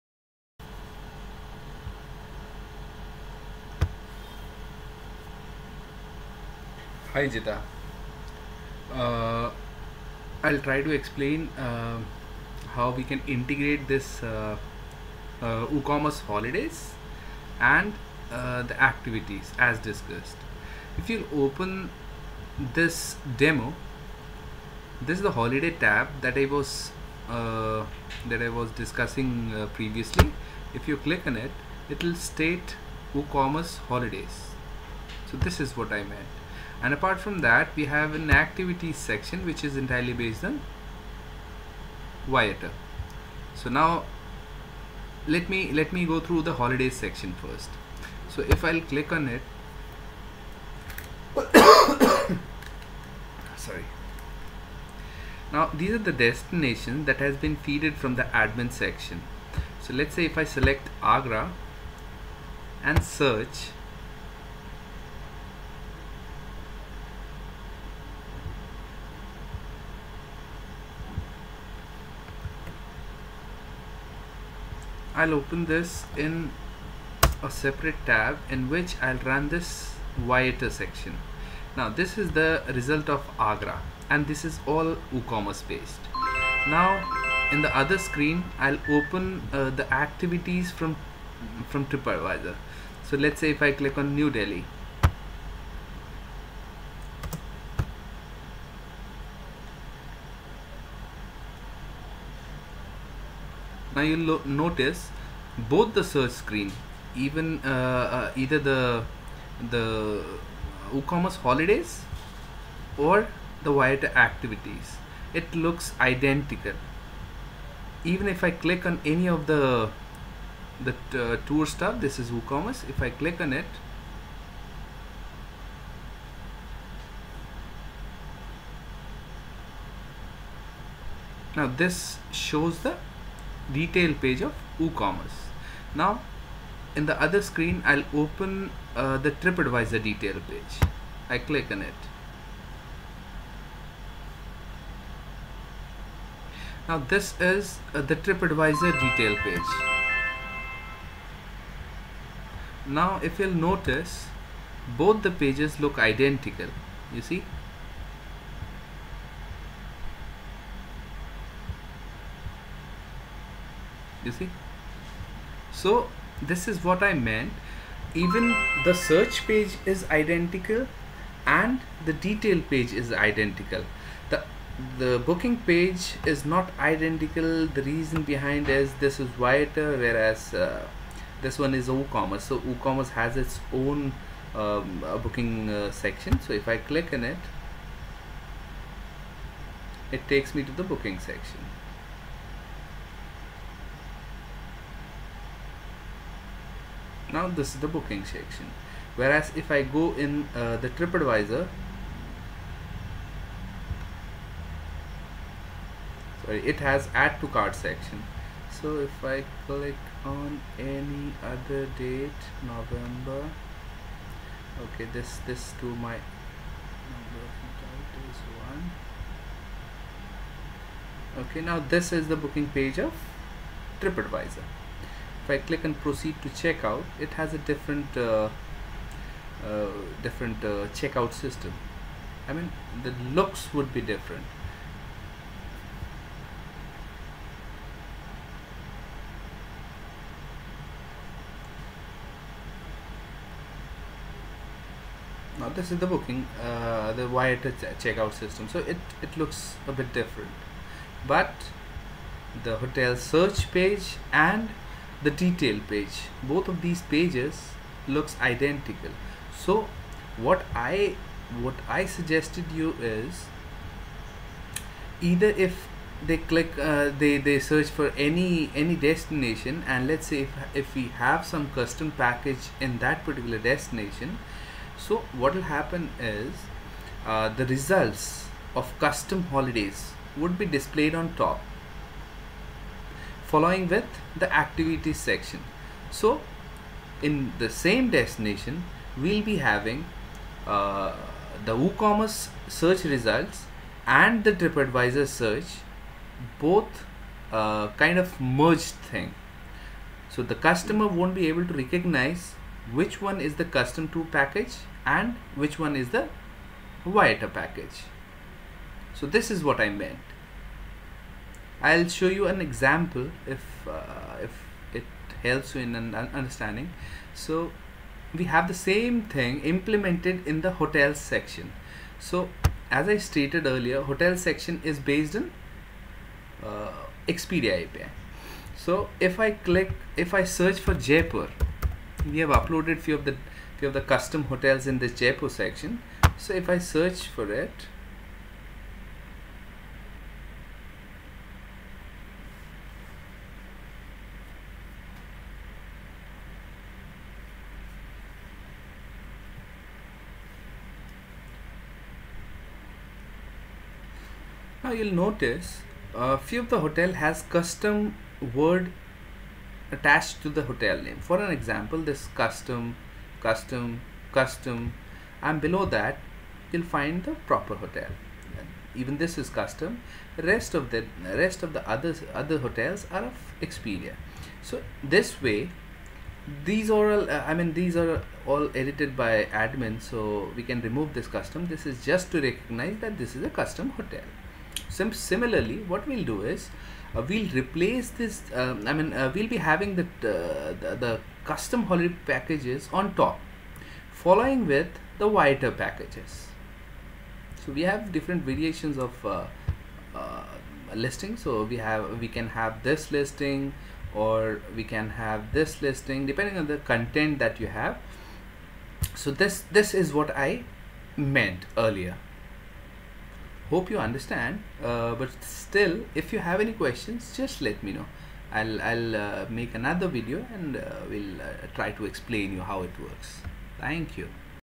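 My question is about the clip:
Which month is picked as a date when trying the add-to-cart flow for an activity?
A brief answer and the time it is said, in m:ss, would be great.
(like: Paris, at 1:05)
November, at 3:32.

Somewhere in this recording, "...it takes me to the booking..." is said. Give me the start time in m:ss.
3:10.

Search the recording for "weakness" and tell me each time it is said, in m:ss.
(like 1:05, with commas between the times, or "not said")
not said.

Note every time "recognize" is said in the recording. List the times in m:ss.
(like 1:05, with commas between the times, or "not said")
5:01, 6:22.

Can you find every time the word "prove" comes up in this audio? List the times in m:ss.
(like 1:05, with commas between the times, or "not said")
not said.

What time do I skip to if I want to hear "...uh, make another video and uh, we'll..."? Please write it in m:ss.
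6:59.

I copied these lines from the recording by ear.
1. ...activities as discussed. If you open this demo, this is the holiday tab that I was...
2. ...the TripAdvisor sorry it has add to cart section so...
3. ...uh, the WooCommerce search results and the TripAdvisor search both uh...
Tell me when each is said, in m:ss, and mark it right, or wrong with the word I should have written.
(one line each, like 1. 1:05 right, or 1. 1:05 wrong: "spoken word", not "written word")
1. 0:18 right
2. 3:20 right
3. 4:50 right.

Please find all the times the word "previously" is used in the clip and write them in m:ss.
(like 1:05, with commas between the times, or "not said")
0:29.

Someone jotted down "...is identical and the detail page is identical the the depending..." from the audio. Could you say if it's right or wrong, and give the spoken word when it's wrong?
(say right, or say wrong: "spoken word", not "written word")
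wrong: "booking", not "depending".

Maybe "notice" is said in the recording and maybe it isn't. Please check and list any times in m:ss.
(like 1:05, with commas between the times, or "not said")
1:44, 2:33, 5:55.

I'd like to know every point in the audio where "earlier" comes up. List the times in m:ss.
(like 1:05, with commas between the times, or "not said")
5:23, 6:51.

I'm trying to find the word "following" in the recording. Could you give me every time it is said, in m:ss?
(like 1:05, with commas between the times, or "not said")
4:43, 6:34.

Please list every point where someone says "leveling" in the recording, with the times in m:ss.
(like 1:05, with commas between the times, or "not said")
not said.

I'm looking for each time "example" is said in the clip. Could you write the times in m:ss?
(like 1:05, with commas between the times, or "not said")
5:12, 6:01.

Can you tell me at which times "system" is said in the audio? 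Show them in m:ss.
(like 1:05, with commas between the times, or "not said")
3:51, 4:08.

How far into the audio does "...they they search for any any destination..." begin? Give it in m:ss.
4:27.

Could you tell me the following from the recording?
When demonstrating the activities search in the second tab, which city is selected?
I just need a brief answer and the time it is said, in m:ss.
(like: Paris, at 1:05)
New Delhi, at 1:34.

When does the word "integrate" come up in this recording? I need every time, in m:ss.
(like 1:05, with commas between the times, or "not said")
0:13.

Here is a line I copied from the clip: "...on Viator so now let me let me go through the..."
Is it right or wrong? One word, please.
right.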